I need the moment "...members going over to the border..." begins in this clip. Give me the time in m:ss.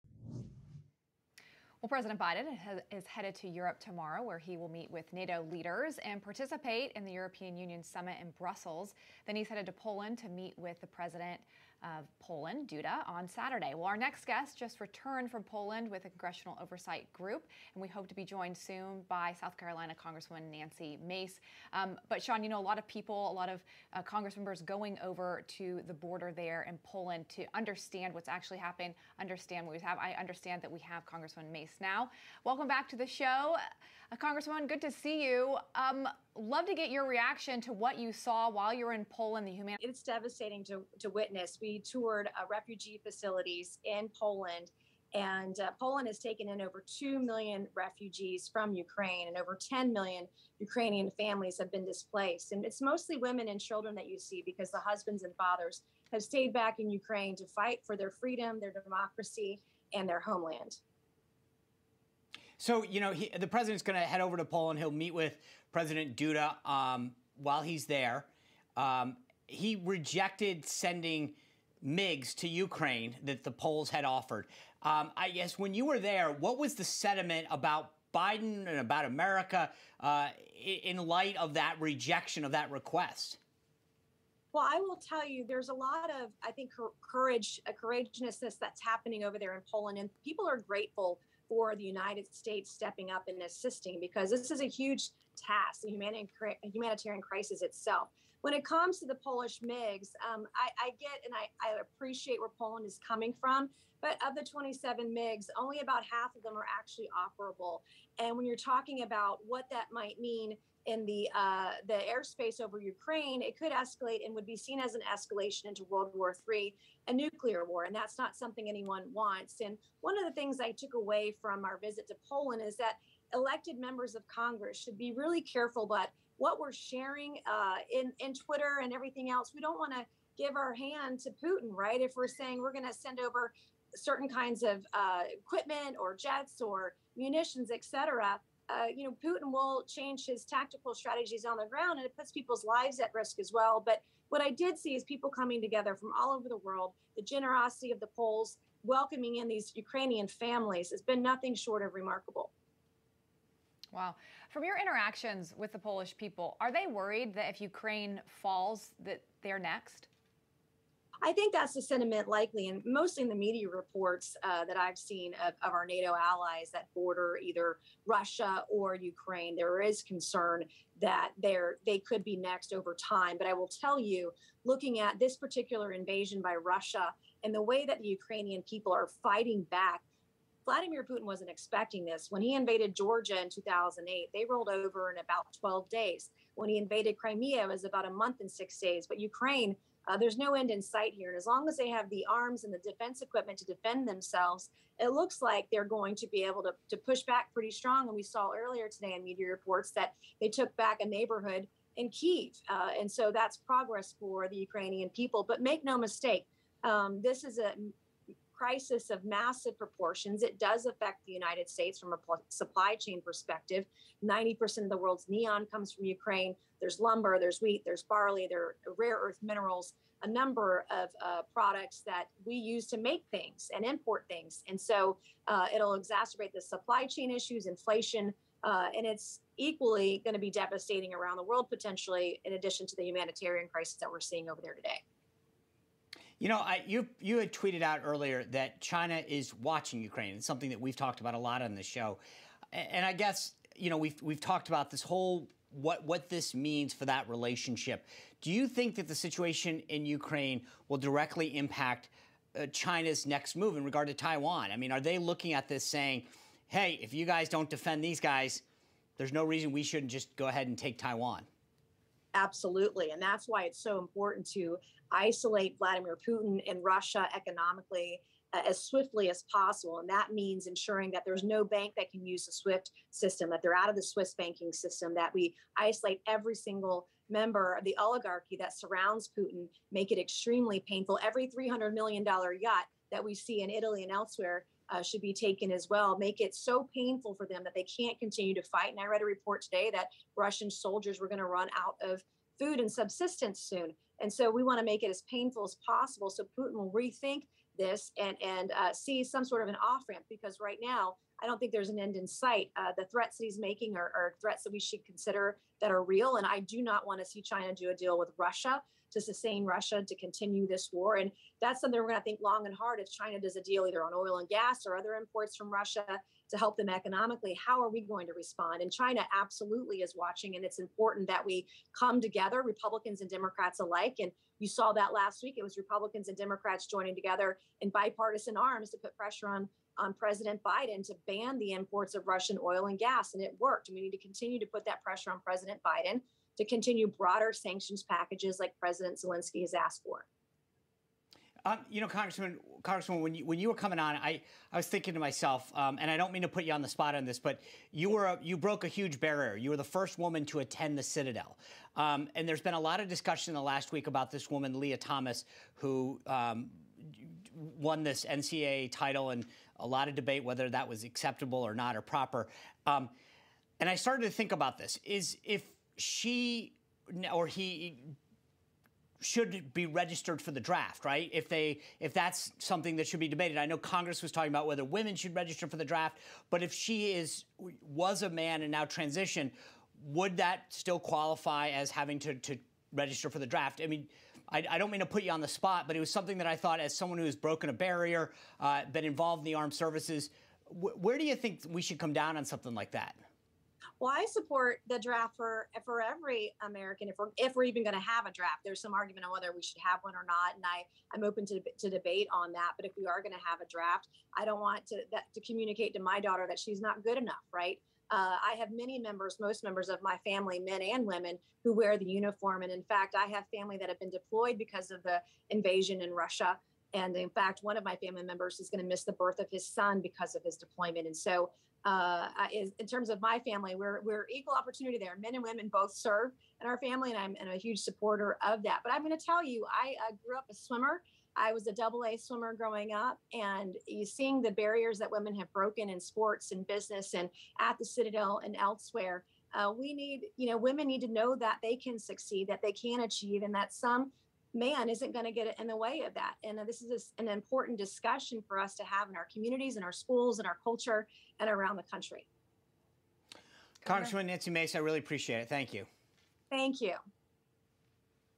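0:24.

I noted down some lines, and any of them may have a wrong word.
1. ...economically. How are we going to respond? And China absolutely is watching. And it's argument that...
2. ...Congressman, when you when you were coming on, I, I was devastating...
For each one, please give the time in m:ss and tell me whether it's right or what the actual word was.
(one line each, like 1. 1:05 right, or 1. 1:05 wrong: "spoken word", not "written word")
1. 5:16 wrong: "important", not "argument"
2. 5:42 wrong: "thinking", not "devastating".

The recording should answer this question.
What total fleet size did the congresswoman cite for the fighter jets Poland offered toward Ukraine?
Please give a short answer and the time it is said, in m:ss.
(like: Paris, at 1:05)
27, at 1:44.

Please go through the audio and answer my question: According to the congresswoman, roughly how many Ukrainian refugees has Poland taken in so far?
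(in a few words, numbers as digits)
over 2 million.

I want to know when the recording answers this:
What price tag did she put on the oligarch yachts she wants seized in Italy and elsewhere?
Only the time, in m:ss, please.
4:41.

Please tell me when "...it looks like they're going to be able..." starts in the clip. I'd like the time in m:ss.
3:14.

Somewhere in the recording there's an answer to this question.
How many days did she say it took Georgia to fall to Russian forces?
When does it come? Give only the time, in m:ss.
3:05.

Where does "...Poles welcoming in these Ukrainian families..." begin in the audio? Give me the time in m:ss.
2:28.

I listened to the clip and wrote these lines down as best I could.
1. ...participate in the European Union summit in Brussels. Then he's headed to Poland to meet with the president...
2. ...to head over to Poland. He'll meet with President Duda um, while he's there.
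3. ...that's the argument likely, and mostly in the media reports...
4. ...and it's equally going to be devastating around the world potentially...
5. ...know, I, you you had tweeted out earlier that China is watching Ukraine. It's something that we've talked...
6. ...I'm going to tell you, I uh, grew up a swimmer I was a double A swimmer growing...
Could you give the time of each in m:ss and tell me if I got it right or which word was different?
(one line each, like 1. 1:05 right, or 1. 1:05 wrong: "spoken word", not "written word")
1. 0:06 right
2. 1:03 right
3. 2:41 wrong: "sentiment", not "argument"
4. 3:48 right
5. 3:56 right
6. 7:08 right.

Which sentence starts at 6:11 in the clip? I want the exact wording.
If they if that's something that should be debated.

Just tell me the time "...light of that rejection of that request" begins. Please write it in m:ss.
1:20.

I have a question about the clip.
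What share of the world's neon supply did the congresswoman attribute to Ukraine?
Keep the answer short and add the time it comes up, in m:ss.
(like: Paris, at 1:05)
90%, at 3:34.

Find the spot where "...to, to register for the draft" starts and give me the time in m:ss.
6:22.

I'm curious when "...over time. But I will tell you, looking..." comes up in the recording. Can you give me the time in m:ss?
2:52.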